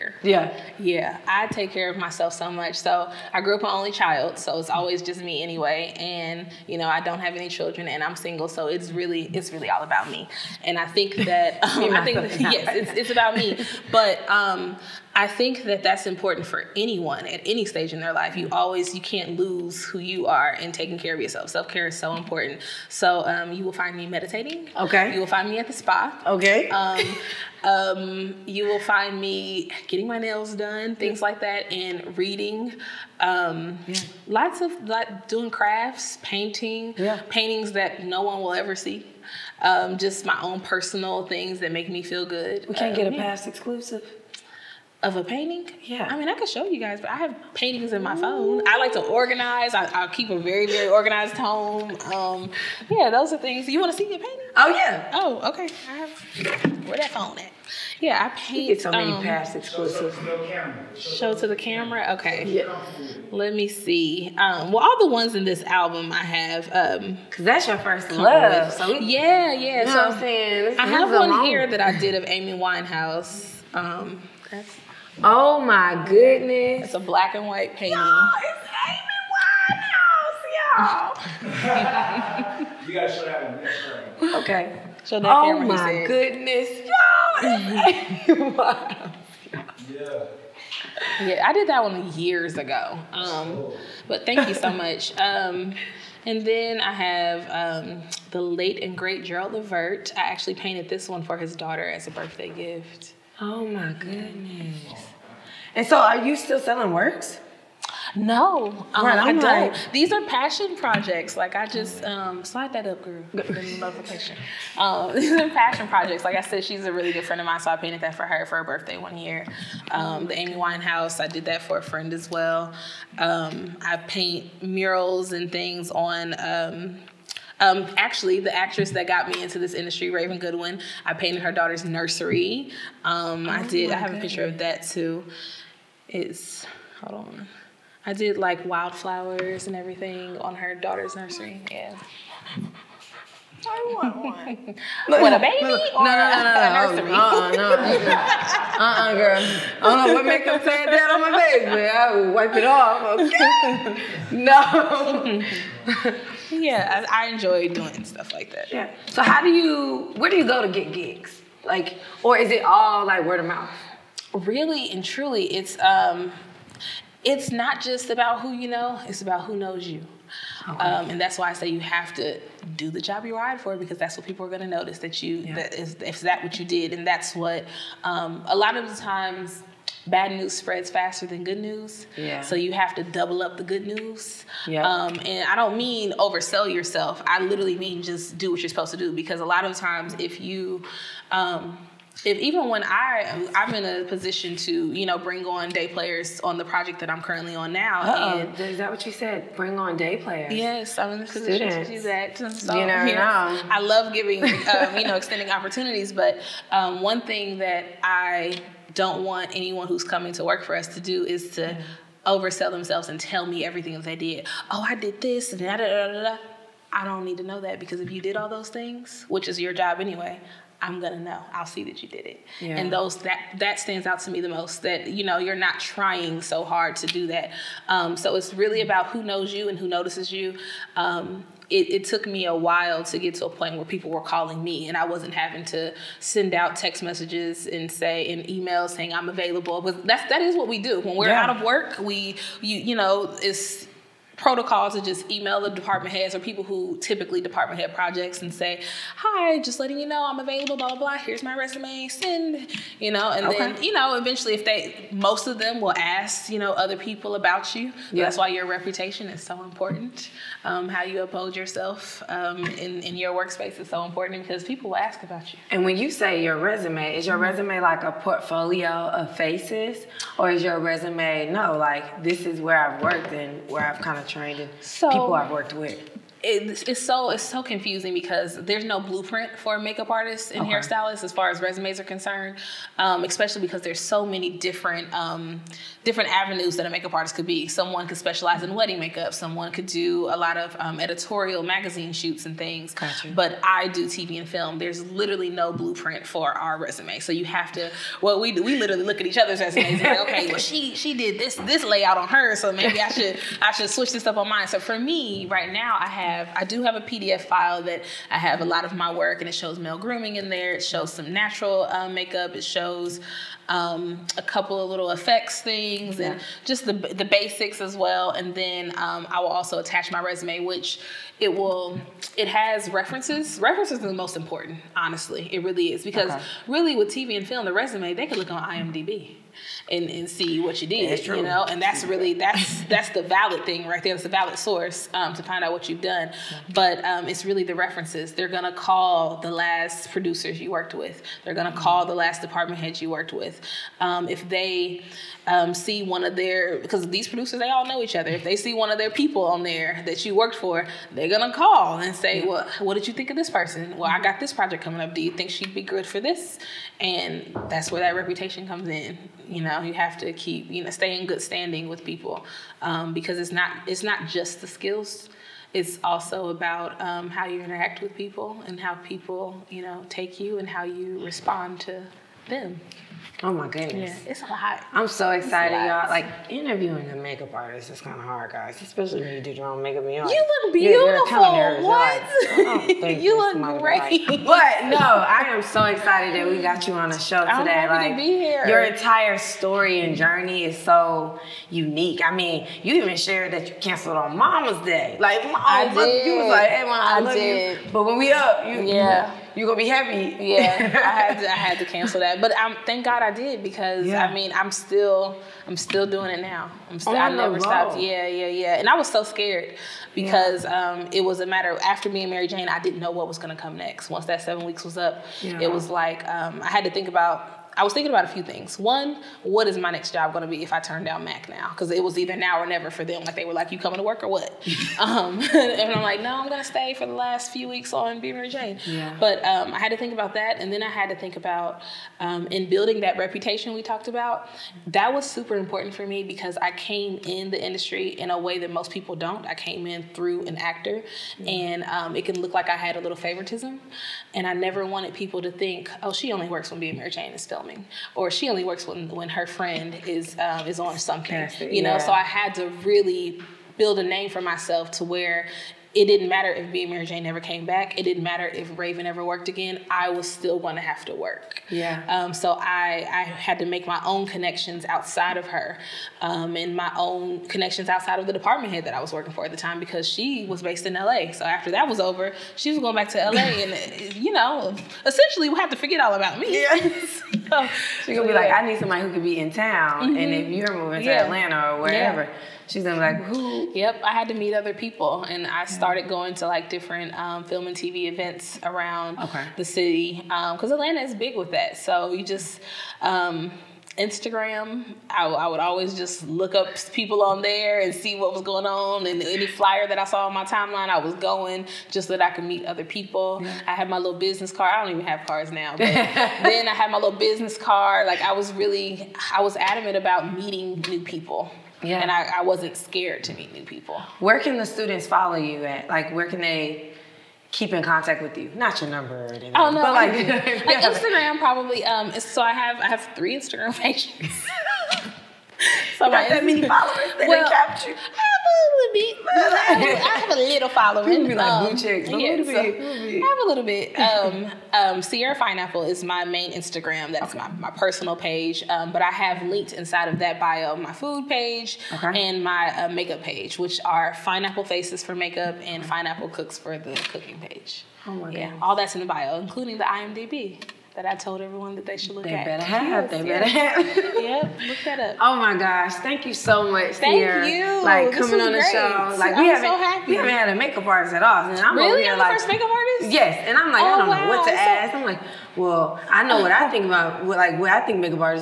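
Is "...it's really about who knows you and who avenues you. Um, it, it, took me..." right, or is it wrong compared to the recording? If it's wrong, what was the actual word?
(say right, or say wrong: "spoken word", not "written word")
wrong: "notices", not "avenues".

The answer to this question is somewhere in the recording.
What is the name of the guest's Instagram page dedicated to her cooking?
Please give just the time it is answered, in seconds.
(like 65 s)
545 s.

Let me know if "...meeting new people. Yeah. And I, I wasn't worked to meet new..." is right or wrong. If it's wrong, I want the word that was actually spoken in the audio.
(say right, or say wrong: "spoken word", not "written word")
wrong: "scared", not "worked".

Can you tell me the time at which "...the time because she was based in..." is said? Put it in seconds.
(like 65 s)
469 s.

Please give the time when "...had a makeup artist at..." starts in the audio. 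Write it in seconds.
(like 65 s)
560 s.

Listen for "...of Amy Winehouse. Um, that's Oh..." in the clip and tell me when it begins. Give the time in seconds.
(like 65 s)
72 s.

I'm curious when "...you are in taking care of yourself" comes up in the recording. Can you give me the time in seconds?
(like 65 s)
19 s.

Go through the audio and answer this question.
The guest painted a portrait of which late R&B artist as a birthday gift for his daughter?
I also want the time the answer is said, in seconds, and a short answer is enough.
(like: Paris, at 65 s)
Gerald Levert, at 99 s.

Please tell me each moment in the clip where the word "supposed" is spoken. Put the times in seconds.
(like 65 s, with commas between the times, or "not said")
188 s.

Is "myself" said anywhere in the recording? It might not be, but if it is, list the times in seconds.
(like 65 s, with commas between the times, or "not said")
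1 s, 454 s.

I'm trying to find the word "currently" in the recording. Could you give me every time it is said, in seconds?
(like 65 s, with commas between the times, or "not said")
197 s.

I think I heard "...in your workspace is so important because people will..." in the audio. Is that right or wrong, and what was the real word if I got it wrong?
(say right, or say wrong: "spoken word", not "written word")
right.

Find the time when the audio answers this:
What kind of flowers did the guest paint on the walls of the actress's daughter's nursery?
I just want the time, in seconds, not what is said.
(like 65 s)
138 s.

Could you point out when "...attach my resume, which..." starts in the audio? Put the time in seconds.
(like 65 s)
319 s.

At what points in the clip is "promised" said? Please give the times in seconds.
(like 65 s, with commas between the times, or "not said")
not said.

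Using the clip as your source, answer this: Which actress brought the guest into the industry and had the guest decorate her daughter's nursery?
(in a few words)
Raven Goodwin.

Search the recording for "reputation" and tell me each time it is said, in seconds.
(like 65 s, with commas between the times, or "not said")
258 s, 358 s, 433 s.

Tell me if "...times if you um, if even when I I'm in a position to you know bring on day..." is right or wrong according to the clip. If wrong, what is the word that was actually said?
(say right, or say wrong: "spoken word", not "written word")
right.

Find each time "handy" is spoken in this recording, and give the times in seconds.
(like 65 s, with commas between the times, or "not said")
not said.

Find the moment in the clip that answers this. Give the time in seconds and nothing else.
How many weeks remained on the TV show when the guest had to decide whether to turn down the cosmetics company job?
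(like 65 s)
414 s.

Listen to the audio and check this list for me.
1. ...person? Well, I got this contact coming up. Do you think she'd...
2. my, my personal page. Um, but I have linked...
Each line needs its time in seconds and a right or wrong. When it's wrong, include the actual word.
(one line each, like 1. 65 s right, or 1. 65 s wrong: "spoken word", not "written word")
1. 353 s wrong: "project", not "contact"
2. 537 s right.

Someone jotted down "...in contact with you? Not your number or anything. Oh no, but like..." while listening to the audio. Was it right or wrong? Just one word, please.
right.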